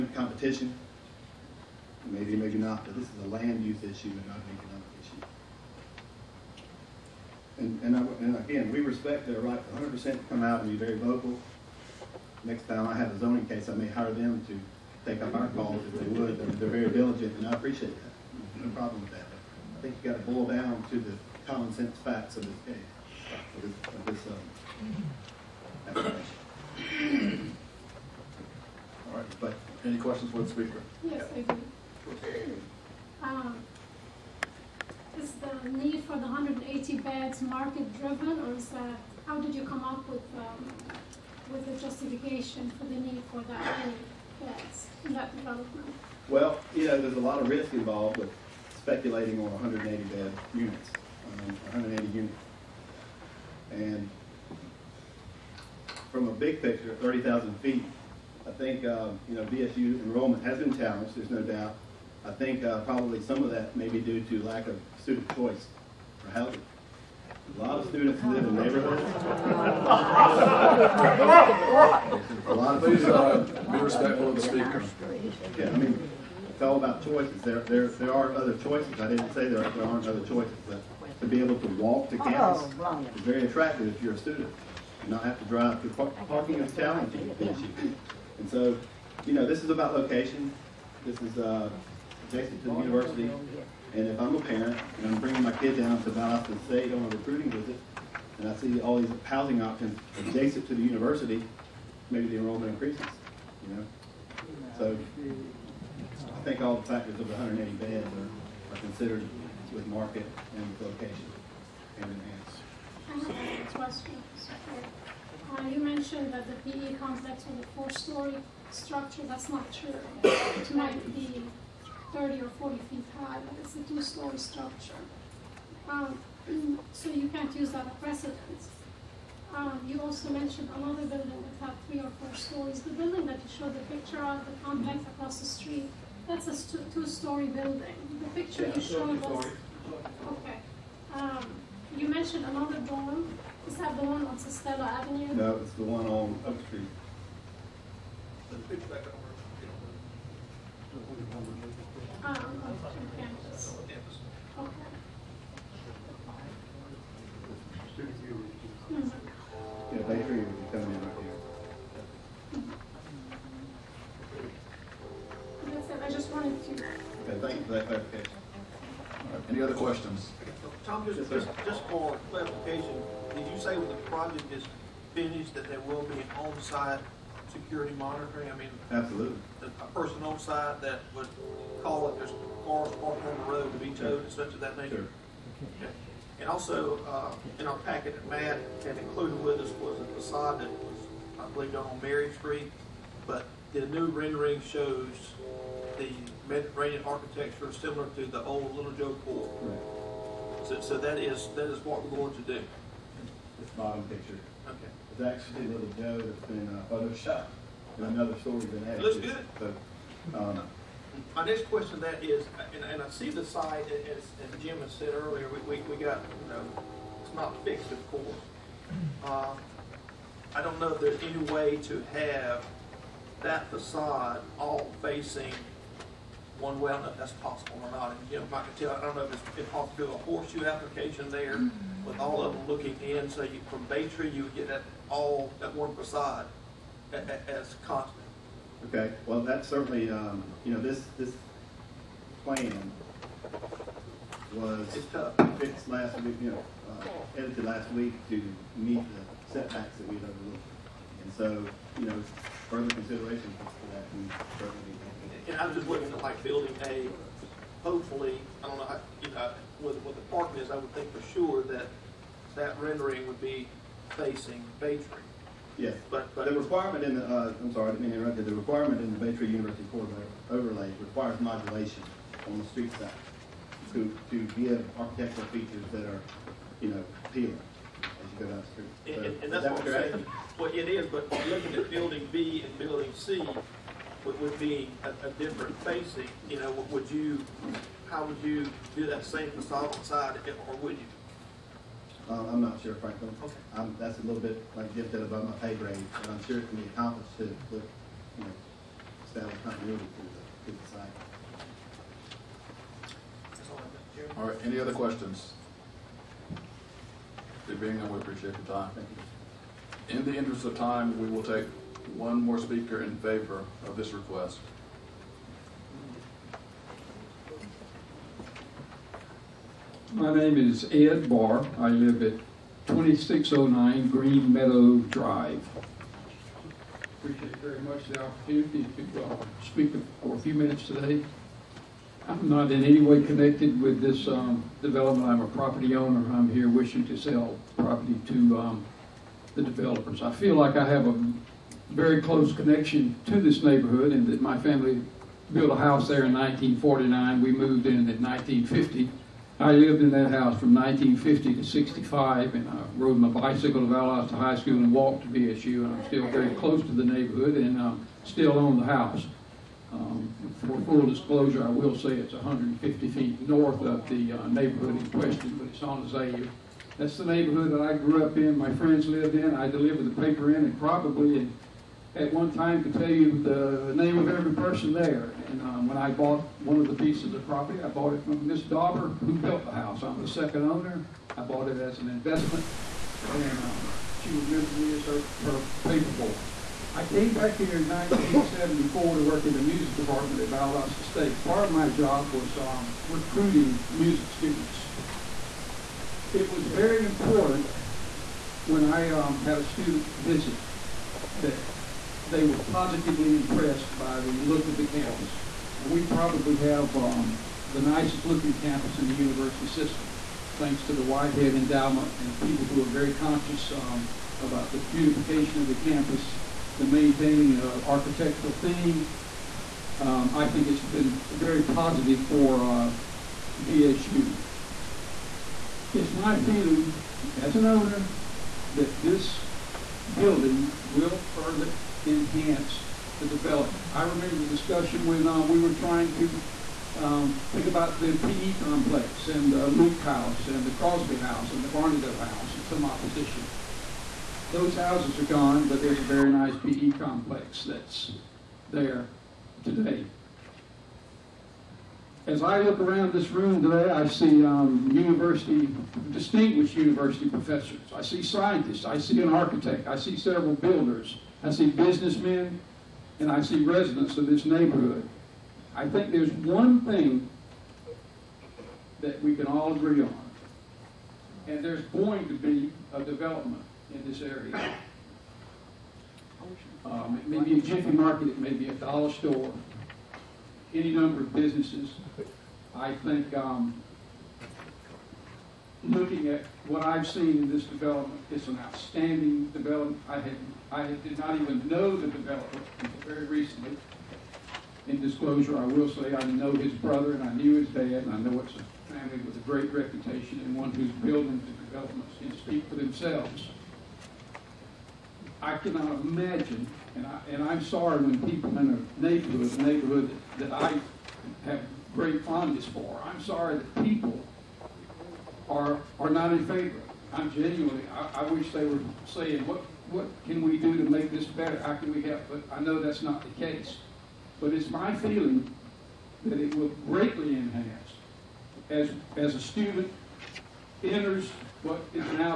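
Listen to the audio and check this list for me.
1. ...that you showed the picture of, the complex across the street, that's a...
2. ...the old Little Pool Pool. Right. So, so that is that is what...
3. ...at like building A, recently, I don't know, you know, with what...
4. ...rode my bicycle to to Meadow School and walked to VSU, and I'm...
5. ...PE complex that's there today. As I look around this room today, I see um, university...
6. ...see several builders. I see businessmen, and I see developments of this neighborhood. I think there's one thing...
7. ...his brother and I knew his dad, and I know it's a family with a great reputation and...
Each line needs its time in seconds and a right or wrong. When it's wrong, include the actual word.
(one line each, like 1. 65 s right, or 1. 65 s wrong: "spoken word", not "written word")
1. 133 s right
2. 198 s wrong: "Joe", not "Pool"
3. 256 s wrong: "hopefully", not "recently"
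4. 352 s wrong: "High", not "Meadow"
5. 446 s right
6. 459 s wrong: "residents", not "developments"
7. 496 s right.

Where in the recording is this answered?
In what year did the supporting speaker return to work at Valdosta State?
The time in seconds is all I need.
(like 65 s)
387 s.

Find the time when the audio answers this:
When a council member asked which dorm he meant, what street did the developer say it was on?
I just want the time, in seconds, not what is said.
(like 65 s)
146 s.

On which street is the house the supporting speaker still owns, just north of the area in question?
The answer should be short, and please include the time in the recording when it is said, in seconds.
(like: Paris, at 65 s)
Azalea, at 366 s.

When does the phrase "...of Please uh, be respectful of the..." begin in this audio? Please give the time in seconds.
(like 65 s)
72 s.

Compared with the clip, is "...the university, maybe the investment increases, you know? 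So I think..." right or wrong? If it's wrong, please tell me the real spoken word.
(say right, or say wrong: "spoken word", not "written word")
wrong: "enrollment", not "investment".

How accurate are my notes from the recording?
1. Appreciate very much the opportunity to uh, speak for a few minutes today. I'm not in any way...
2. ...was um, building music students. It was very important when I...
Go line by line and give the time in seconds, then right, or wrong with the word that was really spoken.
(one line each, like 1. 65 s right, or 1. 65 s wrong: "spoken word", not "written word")
1. 327 s right
2. 392 s wrong: "recruiting", not "building".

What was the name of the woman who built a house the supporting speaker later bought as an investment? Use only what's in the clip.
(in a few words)
Miss Dauber.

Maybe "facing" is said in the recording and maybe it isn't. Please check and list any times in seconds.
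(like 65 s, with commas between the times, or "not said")
225 s, 264 s, 285 s.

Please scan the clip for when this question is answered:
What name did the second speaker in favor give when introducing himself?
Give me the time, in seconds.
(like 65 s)
320 s.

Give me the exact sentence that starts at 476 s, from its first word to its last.
Um, it may be a jiffy market, it may be a dollar store, any number of businesses.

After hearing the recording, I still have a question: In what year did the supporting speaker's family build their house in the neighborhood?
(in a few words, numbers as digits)
1949.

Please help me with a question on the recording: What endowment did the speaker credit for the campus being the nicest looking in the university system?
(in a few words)
Whitehead Endowment.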